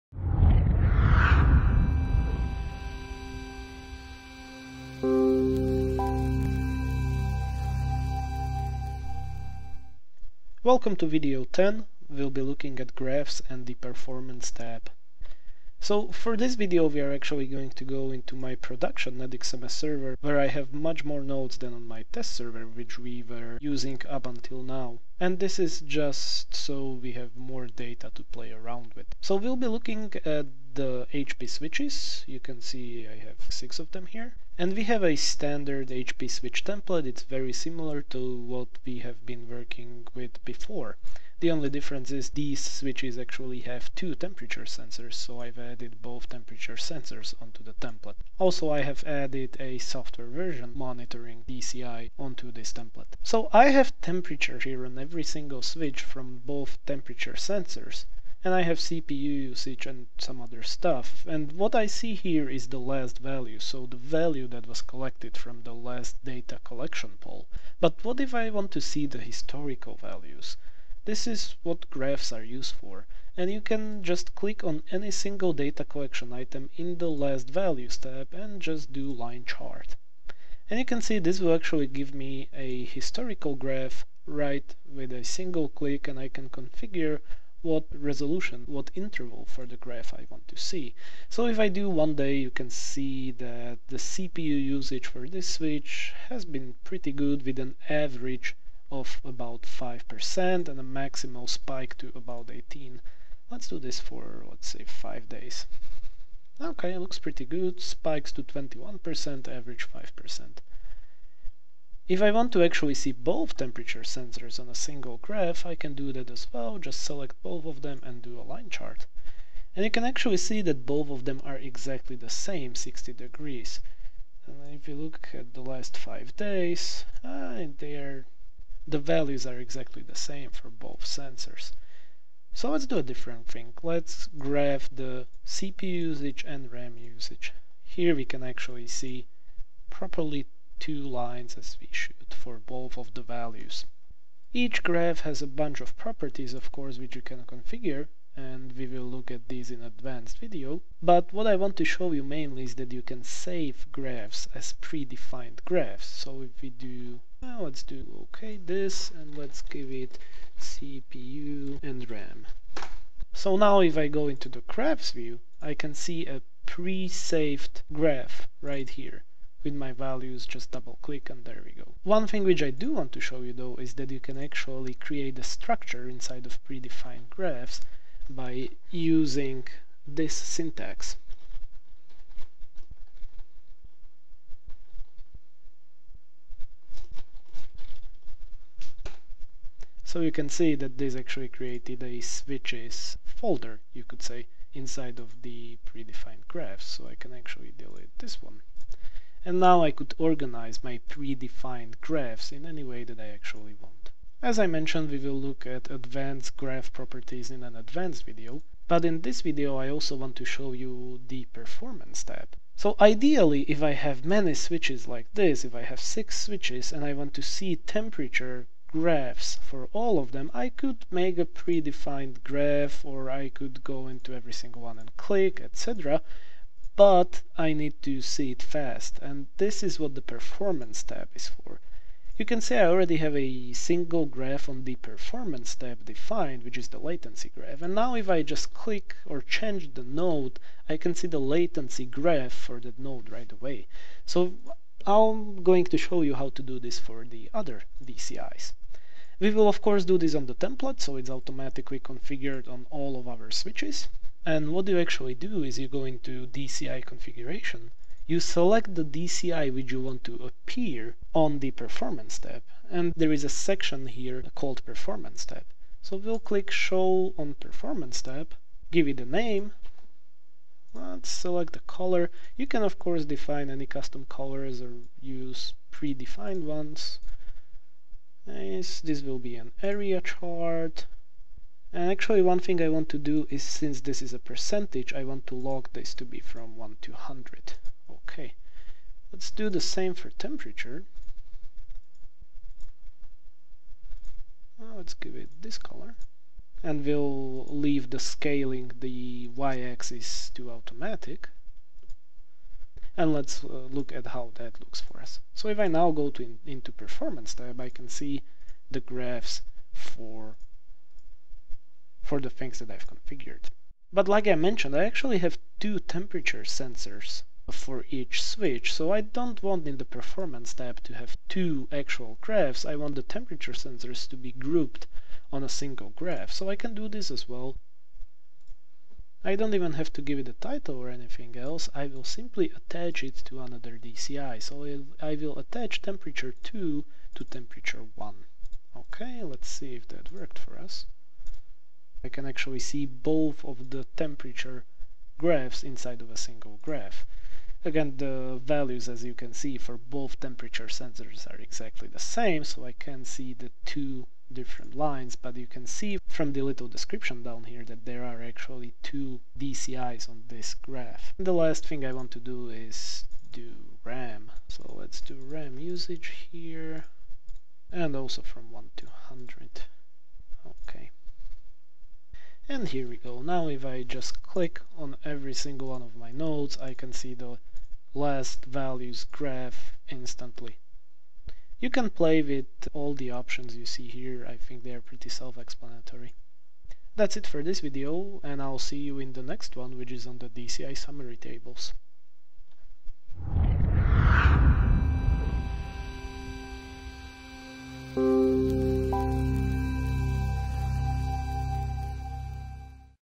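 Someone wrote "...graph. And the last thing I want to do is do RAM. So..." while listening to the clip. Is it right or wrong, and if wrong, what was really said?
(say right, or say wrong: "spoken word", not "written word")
right.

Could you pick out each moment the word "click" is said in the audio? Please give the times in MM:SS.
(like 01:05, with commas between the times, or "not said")
01:14, 01:25, 02:51, 03:45, 03:58, 04:26, 06:14.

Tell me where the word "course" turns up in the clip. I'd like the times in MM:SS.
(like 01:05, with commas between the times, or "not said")
02:26, 04:09, 04:32.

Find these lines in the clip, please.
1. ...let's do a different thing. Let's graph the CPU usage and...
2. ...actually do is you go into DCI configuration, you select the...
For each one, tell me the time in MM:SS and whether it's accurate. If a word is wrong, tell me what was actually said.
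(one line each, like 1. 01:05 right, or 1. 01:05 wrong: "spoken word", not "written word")
1. 02:12 right
2. 04:14 right.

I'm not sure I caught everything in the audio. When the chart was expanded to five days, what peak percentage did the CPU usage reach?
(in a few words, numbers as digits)
21%.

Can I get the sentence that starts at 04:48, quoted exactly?
Okay, let's do the same for temperature.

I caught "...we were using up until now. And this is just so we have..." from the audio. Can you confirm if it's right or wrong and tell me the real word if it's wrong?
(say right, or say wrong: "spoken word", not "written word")
right.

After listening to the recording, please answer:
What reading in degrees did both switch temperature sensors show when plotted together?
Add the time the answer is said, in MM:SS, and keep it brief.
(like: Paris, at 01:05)
60 degrees, at 02:02.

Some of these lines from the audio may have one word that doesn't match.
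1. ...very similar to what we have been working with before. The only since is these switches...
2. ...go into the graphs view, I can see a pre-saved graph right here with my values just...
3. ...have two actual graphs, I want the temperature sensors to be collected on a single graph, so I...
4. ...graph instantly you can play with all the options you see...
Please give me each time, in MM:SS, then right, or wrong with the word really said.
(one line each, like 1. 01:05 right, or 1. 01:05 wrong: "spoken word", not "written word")
1. 00:37 wrong: "difference", not "since"
2. 02:44 right
3. 05:21 wrong: "grouped", not "collected"
4. 06:19 right.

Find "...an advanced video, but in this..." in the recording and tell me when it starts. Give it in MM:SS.
03:27.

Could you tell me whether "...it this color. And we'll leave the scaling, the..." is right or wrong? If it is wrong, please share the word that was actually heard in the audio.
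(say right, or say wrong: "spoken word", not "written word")
right.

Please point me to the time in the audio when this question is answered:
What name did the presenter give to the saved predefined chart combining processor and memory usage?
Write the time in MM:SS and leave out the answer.
02:40.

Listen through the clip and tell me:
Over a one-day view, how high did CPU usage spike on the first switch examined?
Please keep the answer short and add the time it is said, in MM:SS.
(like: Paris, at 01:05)
18, at 01:42.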